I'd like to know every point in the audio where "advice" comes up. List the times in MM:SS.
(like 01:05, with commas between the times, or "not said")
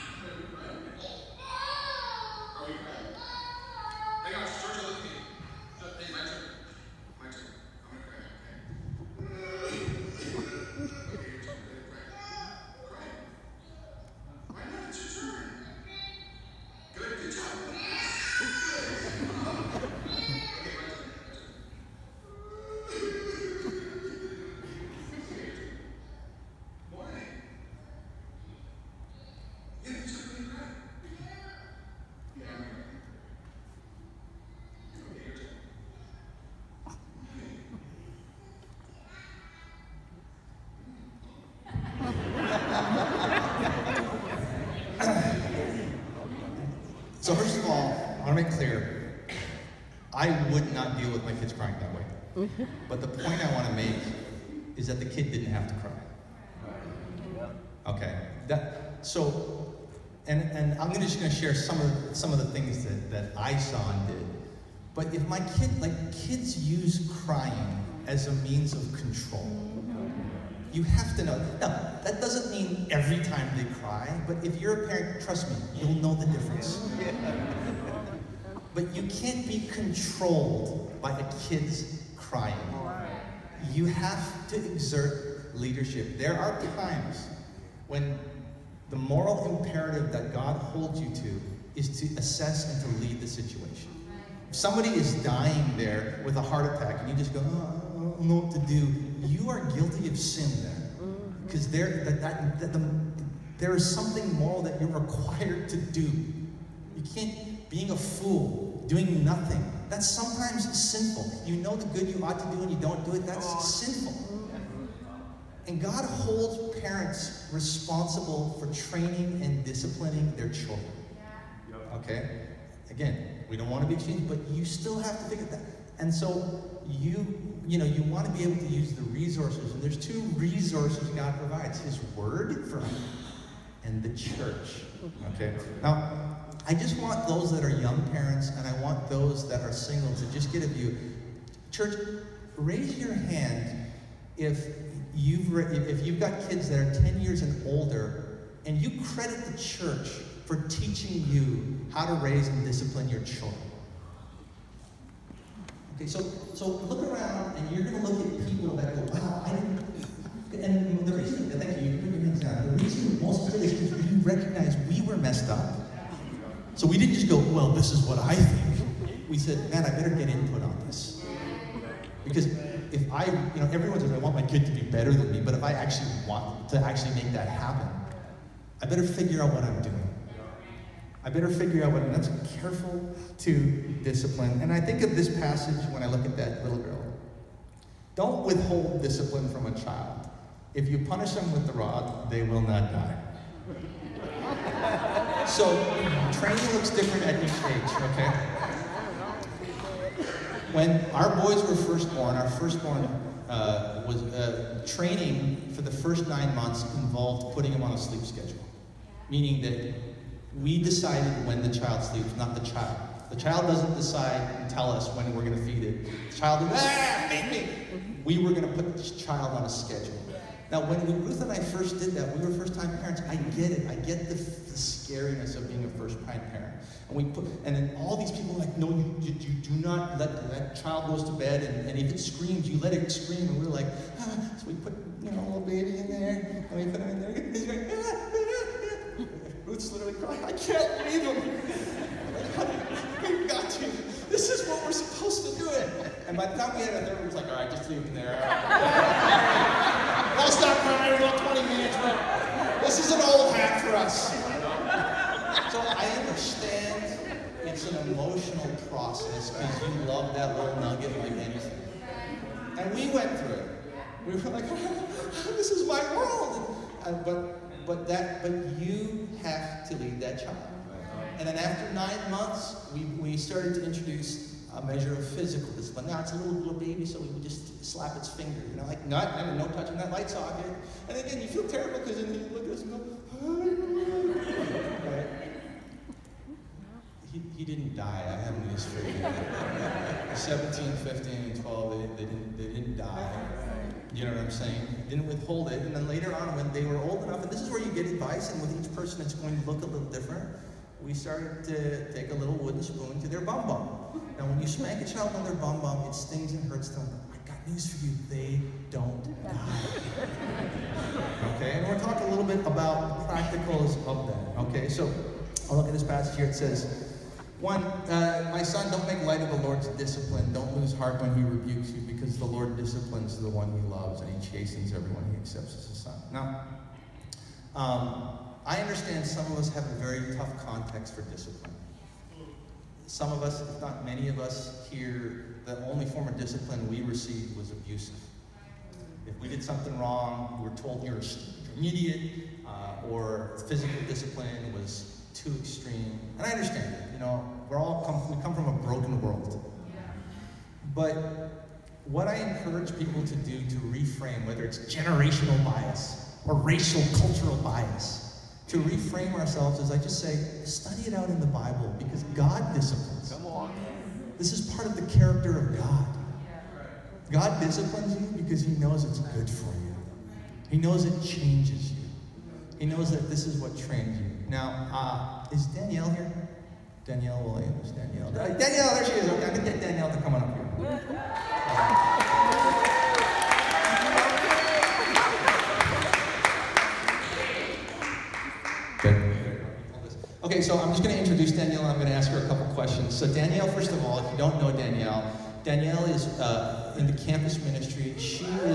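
04:58.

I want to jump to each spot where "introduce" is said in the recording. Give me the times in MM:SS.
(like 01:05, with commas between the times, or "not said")
04:33, 06:31.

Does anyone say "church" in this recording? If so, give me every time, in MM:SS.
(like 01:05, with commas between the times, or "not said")
02:14, 02:21, 02:29.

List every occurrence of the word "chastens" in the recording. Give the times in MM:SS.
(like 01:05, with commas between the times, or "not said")
05:24.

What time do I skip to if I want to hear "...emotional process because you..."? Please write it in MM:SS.
04:18.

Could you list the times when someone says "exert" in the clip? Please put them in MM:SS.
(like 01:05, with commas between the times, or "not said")
01:24.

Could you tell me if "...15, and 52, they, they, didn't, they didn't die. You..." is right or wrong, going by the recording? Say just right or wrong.
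wrong.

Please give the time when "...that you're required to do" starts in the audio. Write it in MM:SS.
01:44.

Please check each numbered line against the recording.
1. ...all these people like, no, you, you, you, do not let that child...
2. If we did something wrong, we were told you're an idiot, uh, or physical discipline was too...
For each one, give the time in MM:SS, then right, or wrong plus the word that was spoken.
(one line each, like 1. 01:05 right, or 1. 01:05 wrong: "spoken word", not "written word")
1. 03:47 right
2. 05:39 right.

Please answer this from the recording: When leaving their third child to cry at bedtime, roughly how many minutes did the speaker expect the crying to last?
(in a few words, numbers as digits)
20 minutes.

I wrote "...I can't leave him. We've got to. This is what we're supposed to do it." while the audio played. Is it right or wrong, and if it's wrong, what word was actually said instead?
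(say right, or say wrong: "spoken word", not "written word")
right.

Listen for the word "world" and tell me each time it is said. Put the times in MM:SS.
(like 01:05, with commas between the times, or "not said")
04:26, 05:49.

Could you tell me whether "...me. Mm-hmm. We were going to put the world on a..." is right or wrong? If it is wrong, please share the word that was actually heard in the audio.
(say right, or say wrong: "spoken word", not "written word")
wrong: "child", not "world".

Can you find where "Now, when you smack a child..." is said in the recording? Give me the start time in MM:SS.
05:04.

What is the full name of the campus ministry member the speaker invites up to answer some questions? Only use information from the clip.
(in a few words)
Danielle Williams.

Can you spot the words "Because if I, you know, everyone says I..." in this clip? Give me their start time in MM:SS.
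02:52.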